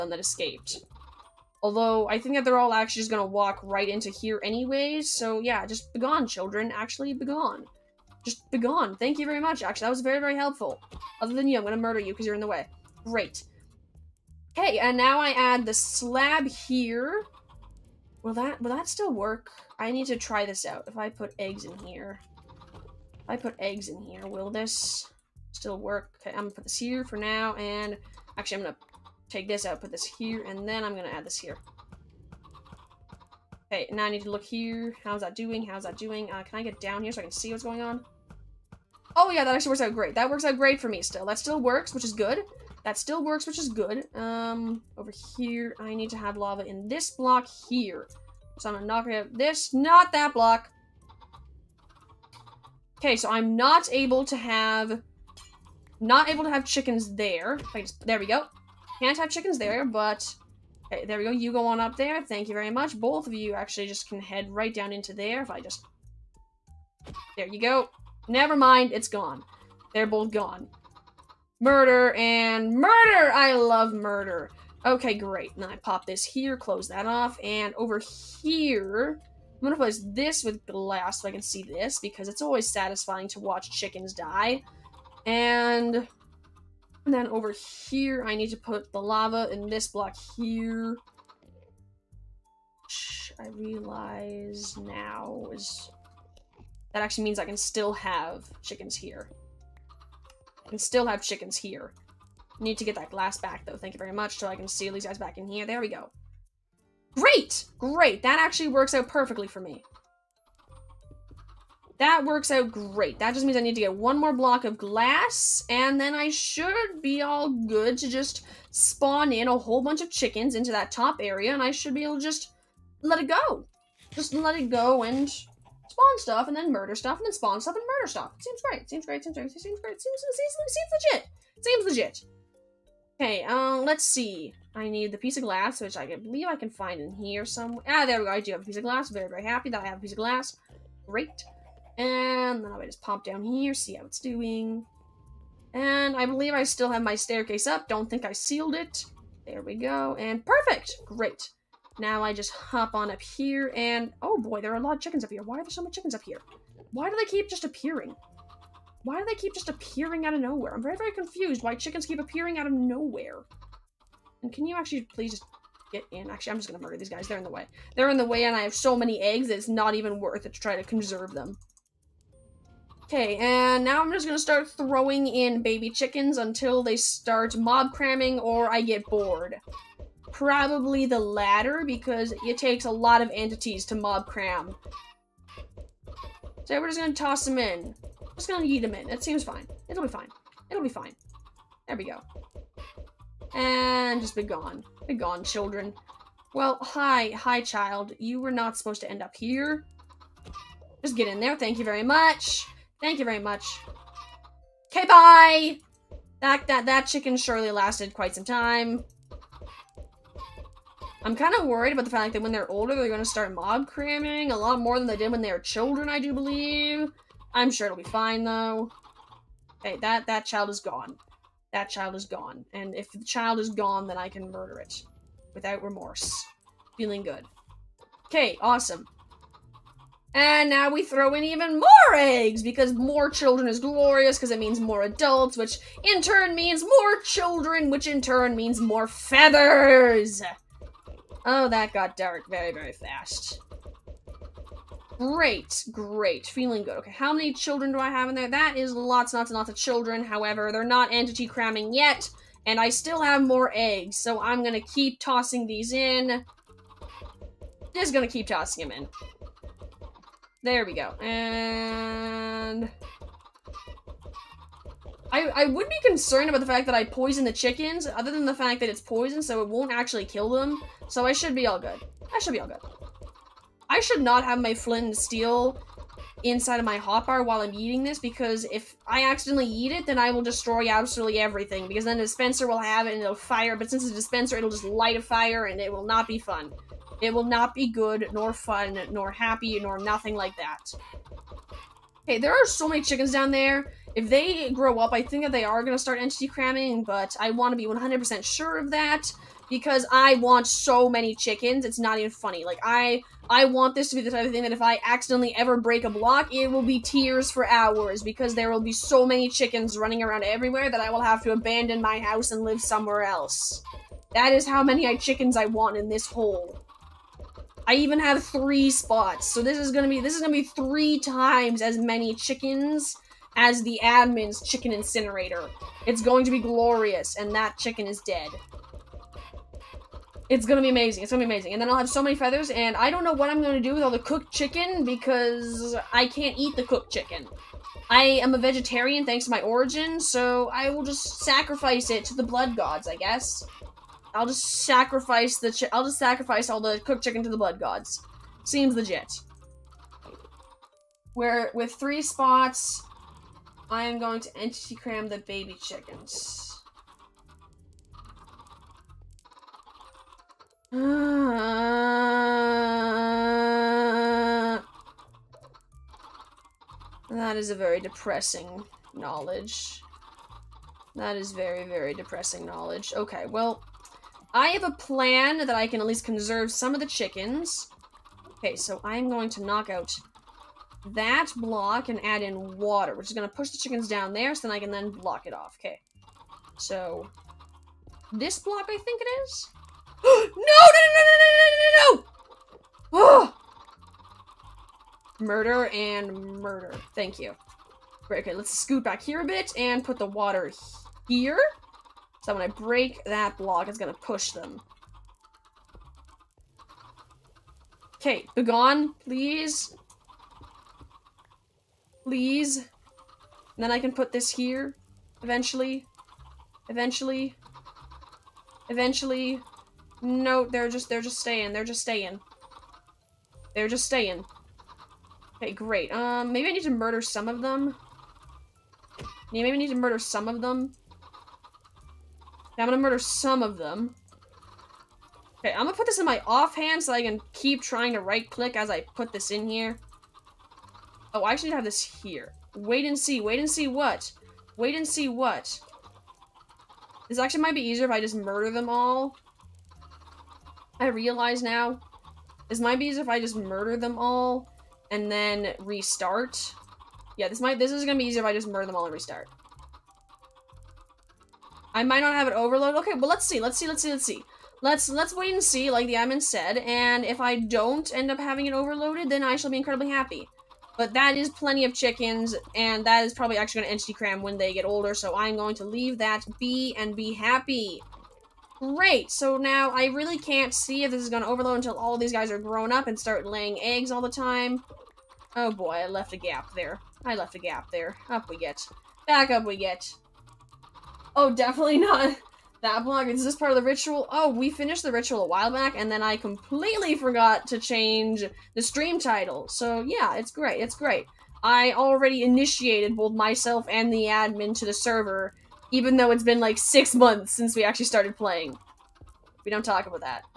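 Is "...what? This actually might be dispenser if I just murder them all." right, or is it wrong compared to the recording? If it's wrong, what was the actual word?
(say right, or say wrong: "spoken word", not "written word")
wrong: "easier", not "dispenser".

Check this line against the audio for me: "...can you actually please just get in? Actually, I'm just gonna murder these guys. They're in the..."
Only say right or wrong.
right.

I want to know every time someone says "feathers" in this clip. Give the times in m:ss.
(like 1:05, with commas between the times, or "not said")
3:59, 5:32.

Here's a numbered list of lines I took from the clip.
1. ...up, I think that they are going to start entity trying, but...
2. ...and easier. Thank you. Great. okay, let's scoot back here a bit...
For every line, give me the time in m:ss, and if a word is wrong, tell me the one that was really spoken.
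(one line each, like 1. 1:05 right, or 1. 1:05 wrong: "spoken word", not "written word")
1. 4:54 wrong: "cramming", not "trying"
2. 6:35 wrong: "murder", not "easier".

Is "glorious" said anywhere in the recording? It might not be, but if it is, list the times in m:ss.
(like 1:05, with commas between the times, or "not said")
3:53, 5:26.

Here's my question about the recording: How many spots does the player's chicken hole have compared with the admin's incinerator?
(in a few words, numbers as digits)
3.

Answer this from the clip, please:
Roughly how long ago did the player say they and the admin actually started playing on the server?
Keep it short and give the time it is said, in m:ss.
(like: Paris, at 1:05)
six months, at 8:26.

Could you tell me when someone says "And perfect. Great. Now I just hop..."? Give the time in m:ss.
2:30.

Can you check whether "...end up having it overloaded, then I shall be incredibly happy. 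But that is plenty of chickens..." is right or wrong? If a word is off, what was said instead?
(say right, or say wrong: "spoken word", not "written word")
right.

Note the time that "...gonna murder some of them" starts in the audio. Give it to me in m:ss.
7:12.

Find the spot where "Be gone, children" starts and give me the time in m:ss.
3:15.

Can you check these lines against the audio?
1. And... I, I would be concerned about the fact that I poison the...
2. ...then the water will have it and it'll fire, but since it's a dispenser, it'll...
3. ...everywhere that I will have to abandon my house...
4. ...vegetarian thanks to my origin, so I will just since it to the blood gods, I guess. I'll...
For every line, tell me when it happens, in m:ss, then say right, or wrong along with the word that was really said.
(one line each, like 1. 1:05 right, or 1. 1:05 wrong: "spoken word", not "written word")
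1. 4:21 right
2. 4:42 wrong: "dispenser", not "water"
3. 5:10 right
4. 5:38 wrong: "sacrifice", not "since".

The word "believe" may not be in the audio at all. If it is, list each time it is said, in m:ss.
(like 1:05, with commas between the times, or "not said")
2:16, 2:26, 3:36.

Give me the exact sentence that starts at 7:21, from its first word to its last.
Oh, I should have this here.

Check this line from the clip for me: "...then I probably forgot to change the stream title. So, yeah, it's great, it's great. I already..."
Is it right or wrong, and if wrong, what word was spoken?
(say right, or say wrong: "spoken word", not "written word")
wrong: "completely", not "probably".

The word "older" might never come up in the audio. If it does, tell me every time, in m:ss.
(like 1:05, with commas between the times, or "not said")
3:32, 7:54.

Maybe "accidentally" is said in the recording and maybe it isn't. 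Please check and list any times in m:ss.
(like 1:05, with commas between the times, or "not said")
4:39, 5:05.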